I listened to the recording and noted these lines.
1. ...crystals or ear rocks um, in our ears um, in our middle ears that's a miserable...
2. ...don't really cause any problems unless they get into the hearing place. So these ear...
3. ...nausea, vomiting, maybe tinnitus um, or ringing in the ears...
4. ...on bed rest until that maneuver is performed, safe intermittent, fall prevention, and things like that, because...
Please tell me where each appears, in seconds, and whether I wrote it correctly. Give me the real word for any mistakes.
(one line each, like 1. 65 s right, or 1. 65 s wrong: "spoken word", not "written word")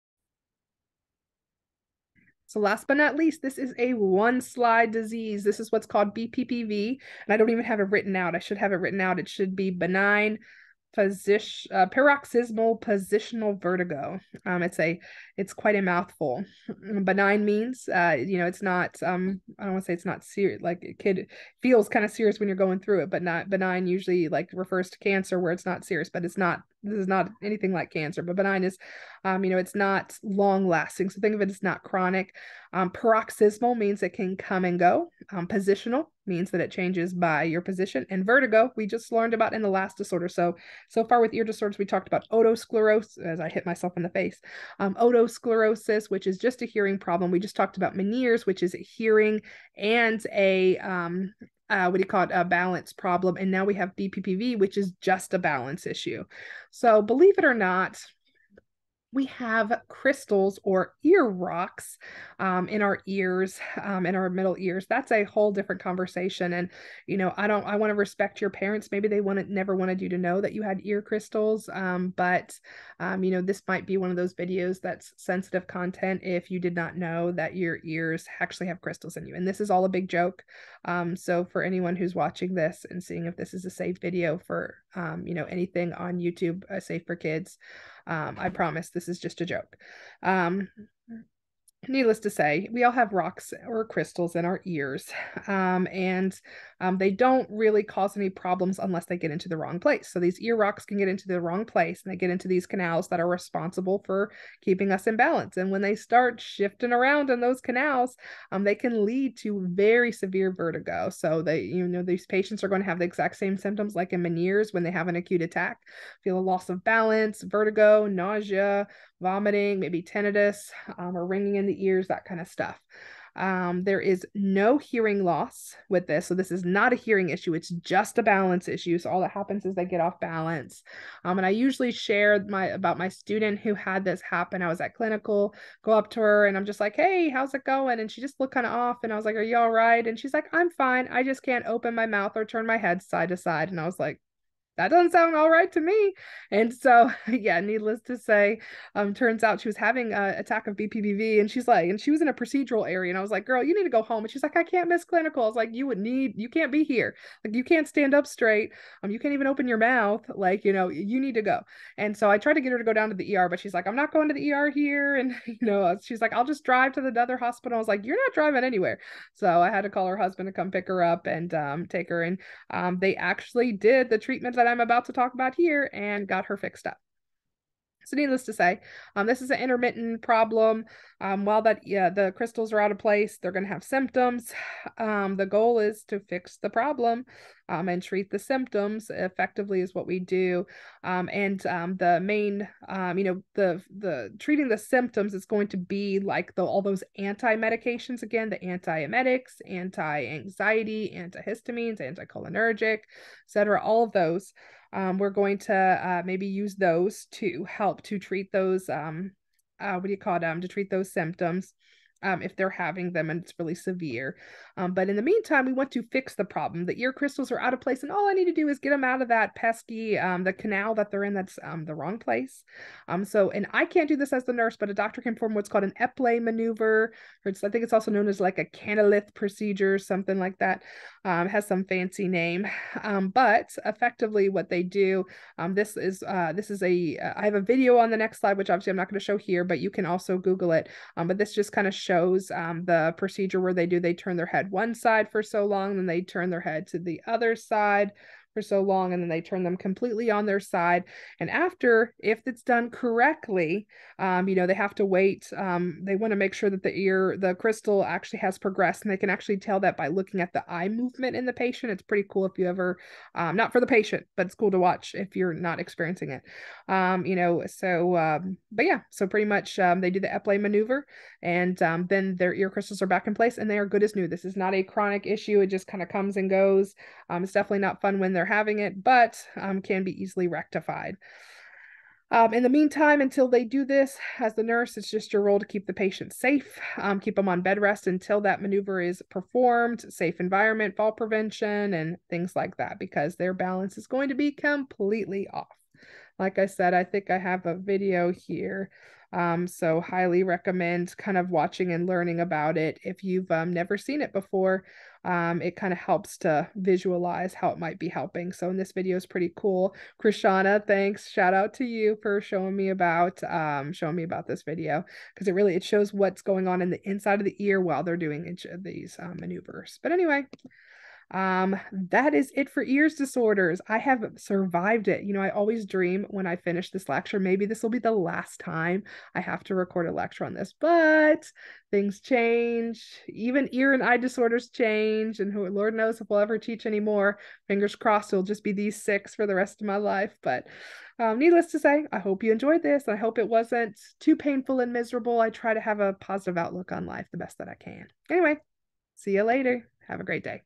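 1. 59 s wrong: "whole", not "miserable"
2. 97 s wrong: "wrong", not "hearing"
3. 118 s right
4. 287 s wrong: "environment", not "intermittent".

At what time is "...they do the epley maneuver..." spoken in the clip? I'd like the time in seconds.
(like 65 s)
270 s.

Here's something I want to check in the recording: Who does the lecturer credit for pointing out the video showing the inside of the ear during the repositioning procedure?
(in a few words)
Krishana.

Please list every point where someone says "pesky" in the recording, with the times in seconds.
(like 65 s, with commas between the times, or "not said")
219 s.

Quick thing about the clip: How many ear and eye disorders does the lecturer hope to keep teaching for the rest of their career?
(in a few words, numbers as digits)
6.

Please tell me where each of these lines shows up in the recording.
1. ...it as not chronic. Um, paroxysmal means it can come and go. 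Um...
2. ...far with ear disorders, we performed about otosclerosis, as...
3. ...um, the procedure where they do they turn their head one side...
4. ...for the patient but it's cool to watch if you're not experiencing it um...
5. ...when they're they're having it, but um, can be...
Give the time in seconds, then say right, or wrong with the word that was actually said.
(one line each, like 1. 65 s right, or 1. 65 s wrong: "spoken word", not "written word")
1. 31 s right
2. 41 s wrong: "talked", not "performed"
3. 242 s right
4. 263 s right
5. 278 s right.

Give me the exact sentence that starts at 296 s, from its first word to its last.
Like I said, I think I have a video here.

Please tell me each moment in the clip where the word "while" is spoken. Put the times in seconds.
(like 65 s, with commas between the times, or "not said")
181 s, 317 s.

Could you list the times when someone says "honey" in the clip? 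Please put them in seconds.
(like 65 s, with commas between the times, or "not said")
not said.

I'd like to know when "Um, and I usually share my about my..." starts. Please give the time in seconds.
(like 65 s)
131 s.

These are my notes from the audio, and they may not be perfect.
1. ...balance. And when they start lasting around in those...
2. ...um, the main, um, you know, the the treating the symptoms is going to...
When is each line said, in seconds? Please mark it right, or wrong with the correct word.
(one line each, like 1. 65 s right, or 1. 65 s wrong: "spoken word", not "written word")
1. 105 s wrong: "shifting", not "lasting"
2. 191 s right.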